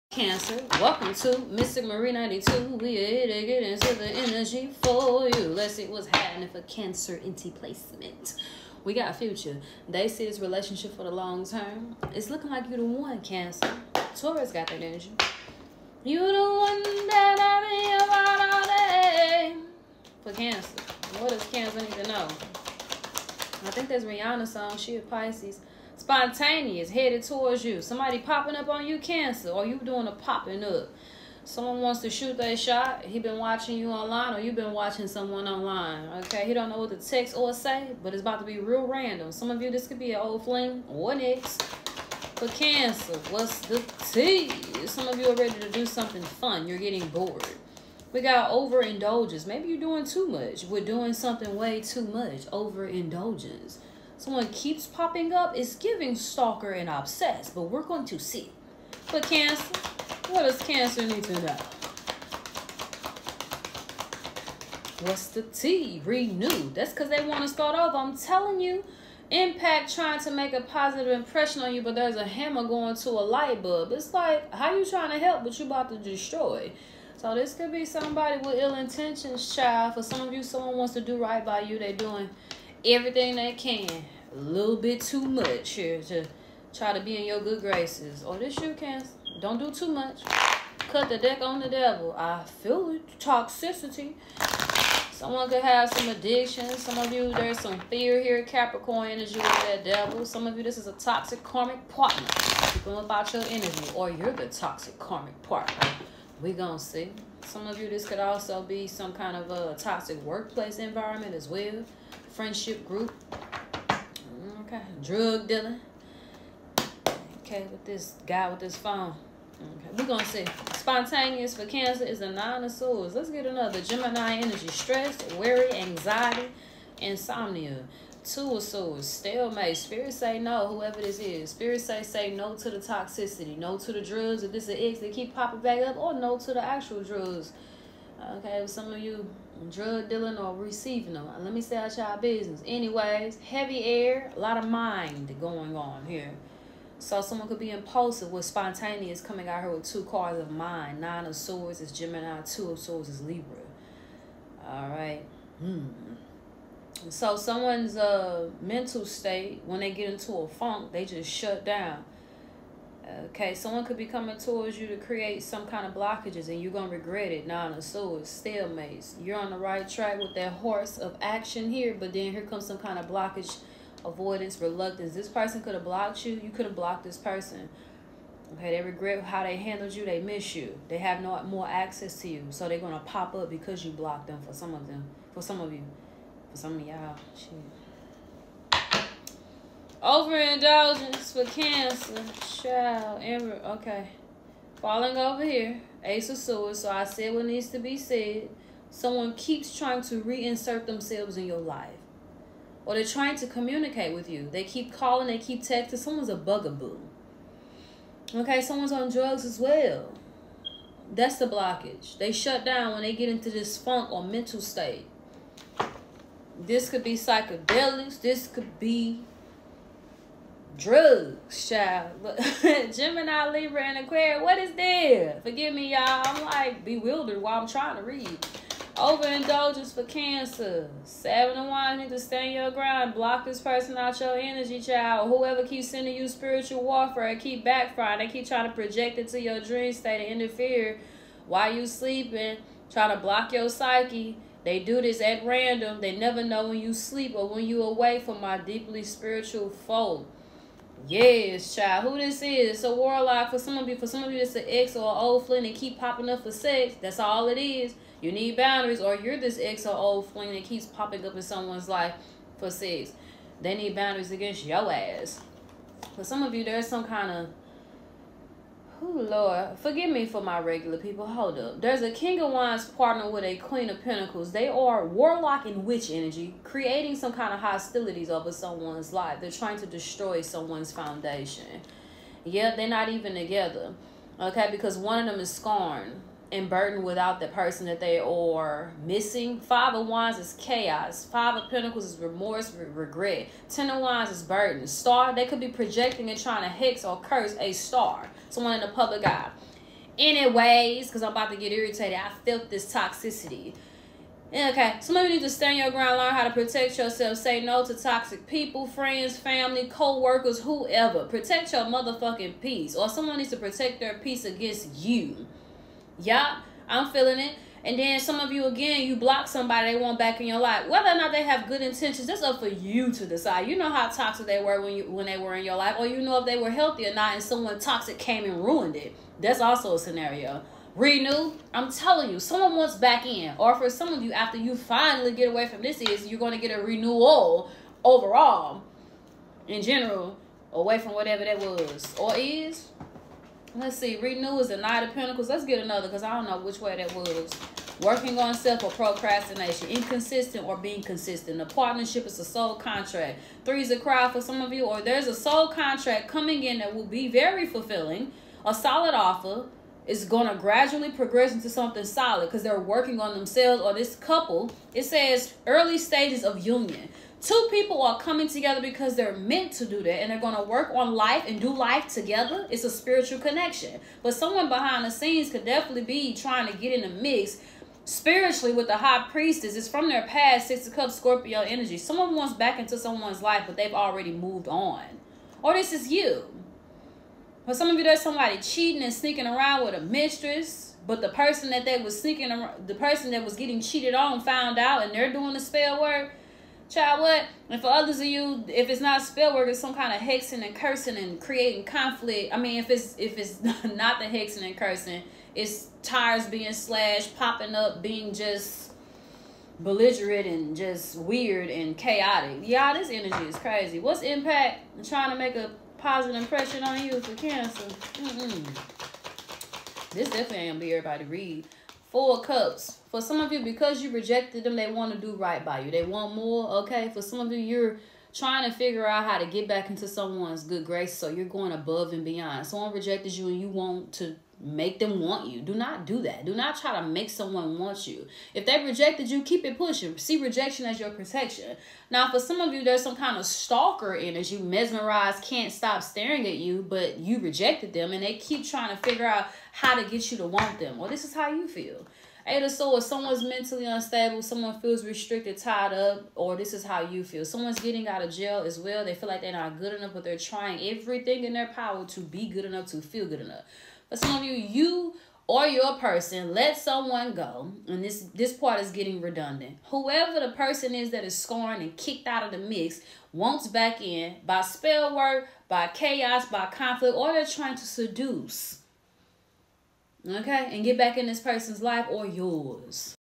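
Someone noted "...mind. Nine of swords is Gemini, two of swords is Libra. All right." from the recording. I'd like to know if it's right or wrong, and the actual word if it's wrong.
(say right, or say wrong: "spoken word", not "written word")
right.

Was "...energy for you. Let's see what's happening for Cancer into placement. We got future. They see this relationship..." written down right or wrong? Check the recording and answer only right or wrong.
right.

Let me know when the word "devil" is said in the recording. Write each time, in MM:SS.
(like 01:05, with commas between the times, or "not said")
01:31, 01:39.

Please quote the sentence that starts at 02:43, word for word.
Okay, someone could be coming towards you to create some kind of blockages and you're going to regret it.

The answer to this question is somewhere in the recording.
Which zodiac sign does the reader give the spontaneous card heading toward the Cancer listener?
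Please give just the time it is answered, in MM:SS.
00:24.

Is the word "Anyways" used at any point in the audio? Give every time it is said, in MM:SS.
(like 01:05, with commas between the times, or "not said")
02:22, 05:00.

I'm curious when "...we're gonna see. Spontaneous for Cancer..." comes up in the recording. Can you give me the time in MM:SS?
01:59.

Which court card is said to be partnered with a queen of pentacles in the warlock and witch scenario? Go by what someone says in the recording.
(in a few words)
King of wands.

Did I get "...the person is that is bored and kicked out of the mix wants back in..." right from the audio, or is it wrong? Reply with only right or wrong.
wrong.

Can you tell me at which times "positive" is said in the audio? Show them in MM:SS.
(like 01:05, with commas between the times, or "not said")
01:10, 06:55.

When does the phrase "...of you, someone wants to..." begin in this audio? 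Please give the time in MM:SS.
01:20.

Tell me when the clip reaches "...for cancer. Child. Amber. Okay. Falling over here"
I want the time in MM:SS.
03:11.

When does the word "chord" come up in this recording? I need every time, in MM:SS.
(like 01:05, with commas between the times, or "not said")
not said.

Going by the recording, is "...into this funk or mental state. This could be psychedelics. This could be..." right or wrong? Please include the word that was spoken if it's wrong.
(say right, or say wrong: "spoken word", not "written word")
right.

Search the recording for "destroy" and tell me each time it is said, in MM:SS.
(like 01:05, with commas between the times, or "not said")
01:15, 04:39.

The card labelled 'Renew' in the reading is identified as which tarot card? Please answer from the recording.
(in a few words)
Knight of Pentacles.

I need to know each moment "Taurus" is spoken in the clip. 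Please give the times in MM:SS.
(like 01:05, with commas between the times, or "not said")
00:14.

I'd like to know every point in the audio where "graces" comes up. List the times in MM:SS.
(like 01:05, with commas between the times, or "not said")
01:27, 07:10.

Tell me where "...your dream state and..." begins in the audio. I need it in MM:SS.
03:59.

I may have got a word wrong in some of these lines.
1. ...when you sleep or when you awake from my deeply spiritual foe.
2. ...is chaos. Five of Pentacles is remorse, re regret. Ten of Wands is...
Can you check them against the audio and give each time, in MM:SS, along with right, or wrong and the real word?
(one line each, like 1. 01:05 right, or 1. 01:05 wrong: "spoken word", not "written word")
1. 04:06 right
2. 04:50 right.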